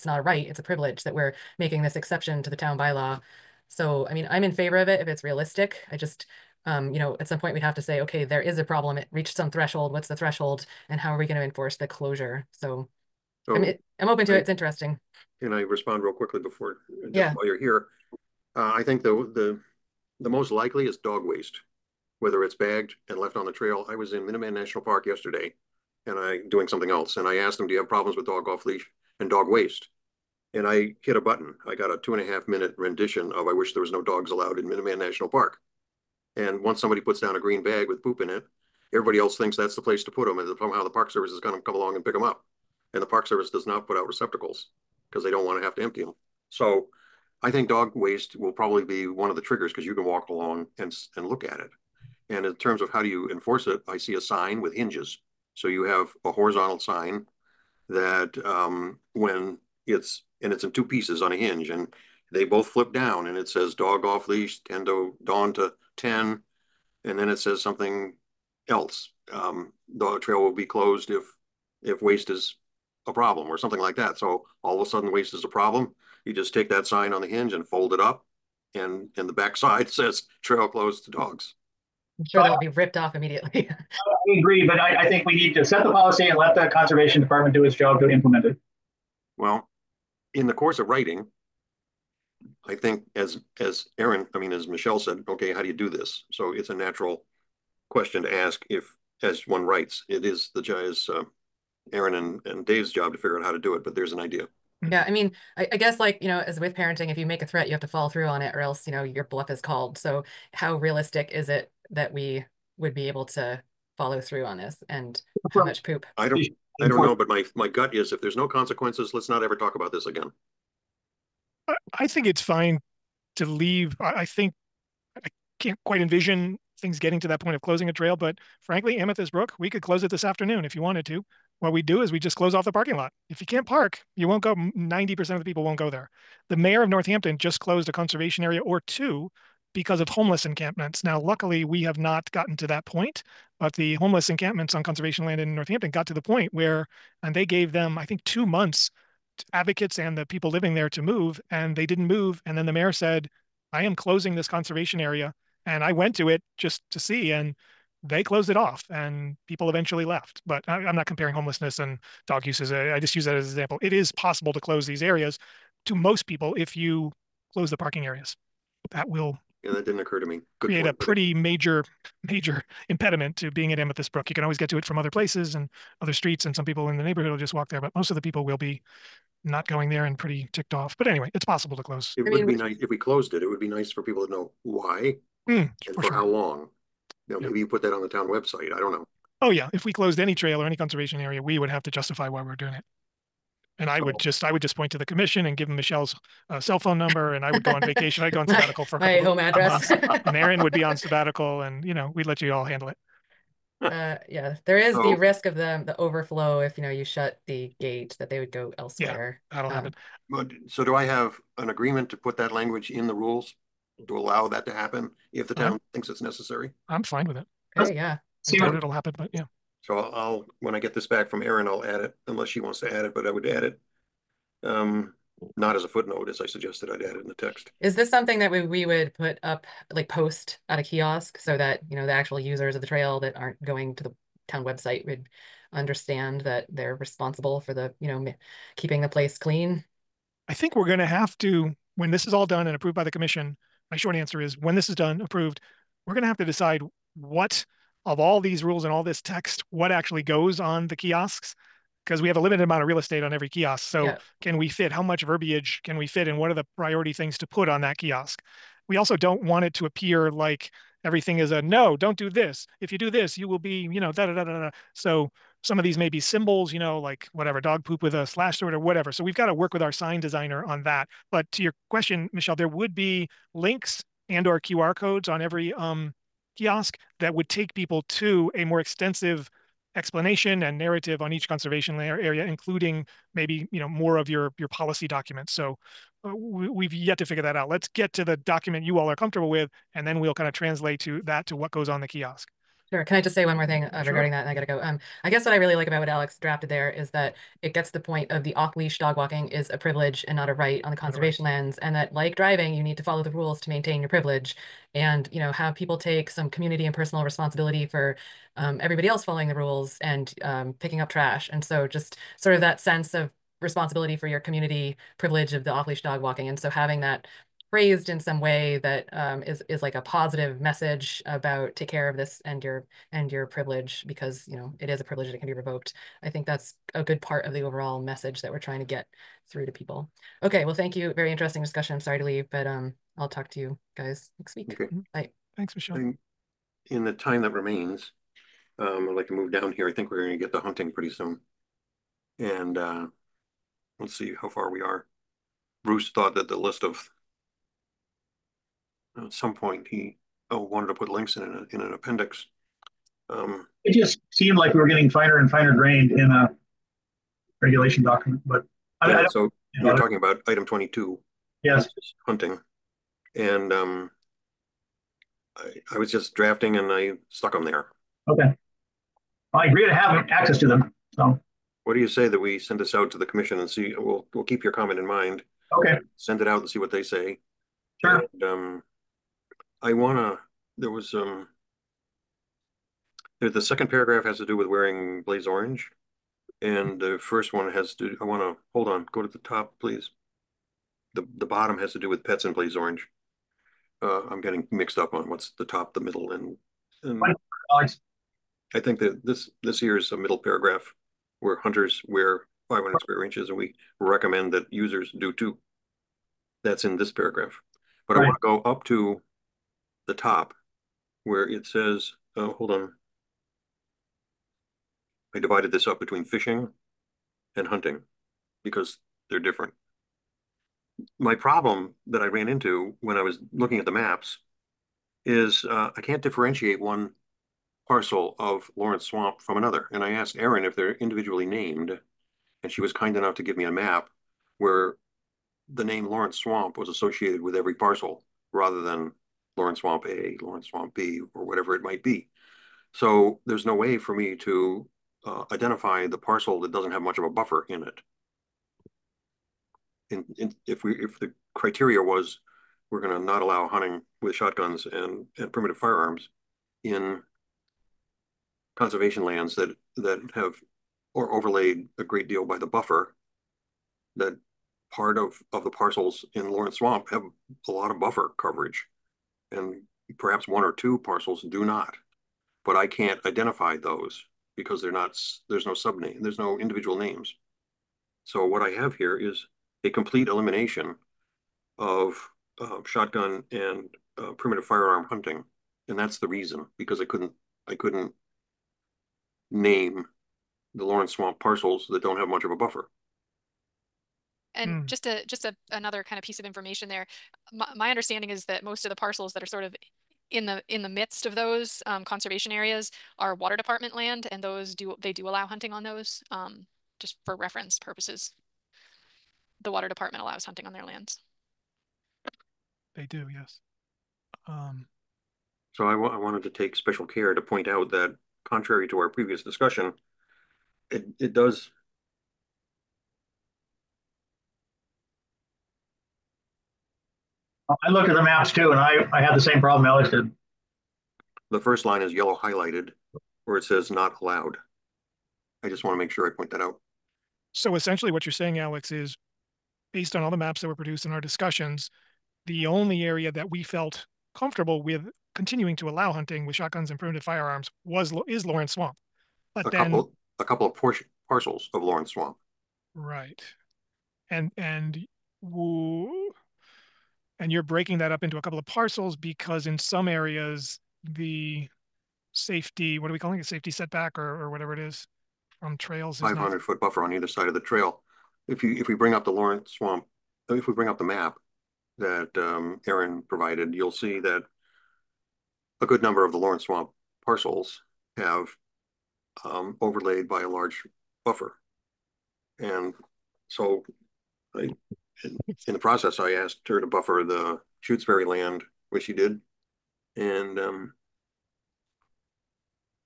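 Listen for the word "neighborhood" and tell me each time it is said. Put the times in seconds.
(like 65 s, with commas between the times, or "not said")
177 s.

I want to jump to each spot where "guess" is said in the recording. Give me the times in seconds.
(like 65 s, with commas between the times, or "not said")
105 s, 295 s.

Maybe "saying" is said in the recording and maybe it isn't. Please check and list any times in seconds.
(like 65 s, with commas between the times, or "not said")
538 s.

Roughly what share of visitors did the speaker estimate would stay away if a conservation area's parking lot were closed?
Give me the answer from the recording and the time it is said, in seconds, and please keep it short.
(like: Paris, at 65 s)
90 percent, at 134 s.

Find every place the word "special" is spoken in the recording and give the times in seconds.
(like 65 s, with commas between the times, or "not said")
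516 s.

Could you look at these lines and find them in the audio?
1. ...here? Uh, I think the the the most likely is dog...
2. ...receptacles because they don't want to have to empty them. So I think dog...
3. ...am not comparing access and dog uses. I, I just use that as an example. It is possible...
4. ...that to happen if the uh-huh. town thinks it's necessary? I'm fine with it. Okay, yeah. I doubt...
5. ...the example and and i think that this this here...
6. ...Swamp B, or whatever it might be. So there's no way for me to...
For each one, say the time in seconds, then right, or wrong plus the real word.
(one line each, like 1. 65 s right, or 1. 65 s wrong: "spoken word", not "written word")
1. 17 s right
2. 44 s right
3. 160 s wrong: "homelessness", not "access"
4. 214 s right
5. 395 s wrong: "middle", not "example"
6. 440 s right.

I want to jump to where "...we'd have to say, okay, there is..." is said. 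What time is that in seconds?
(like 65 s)
7 s.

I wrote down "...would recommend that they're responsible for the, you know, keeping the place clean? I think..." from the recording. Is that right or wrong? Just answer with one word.
wrong.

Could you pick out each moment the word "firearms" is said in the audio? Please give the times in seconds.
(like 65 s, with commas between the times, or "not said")
455 s, 484 s, 547 s.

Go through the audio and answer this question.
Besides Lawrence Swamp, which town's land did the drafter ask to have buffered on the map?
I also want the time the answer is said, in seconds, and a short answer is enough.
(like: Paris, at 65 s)
Shutesbury, at 587 s.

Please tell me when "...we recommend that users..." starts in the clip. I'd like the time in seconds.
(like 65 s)
403 s.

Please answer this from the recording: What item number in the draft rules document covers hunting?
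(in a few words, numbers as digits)
22.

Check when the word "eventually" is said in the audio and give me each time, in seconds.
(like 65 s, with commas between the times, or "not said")
159 s.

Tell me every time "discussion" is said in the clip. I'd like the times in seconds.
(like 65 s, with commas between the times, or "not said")
331 s, 519 s, 541 s.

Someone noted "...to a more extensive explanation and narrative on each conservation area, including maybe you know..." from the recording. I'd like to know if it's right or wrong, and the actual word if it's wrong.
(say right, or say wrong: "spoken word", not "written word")
right.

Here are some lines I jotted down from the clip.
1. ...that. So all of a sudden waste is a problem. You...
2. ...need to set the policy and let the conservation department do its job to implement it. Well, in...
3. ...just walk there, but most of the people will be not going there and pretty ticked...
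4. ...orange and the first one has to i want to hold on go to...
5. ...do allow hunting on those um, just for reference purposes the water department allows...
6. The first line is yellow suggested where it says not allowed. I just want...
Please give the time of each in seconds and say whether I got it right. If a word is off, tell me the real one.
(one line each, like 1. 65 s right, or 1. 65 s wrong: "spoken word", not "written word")
1. 73 s right
2. 85 s right
3. 177 s right
4. 385 s right
5. 505 s right
6. 531 s wrong: "highlighted", not "suggested".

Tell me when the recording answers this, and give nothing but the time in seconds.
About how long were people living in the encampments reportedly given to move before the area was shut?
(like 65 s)
148 s.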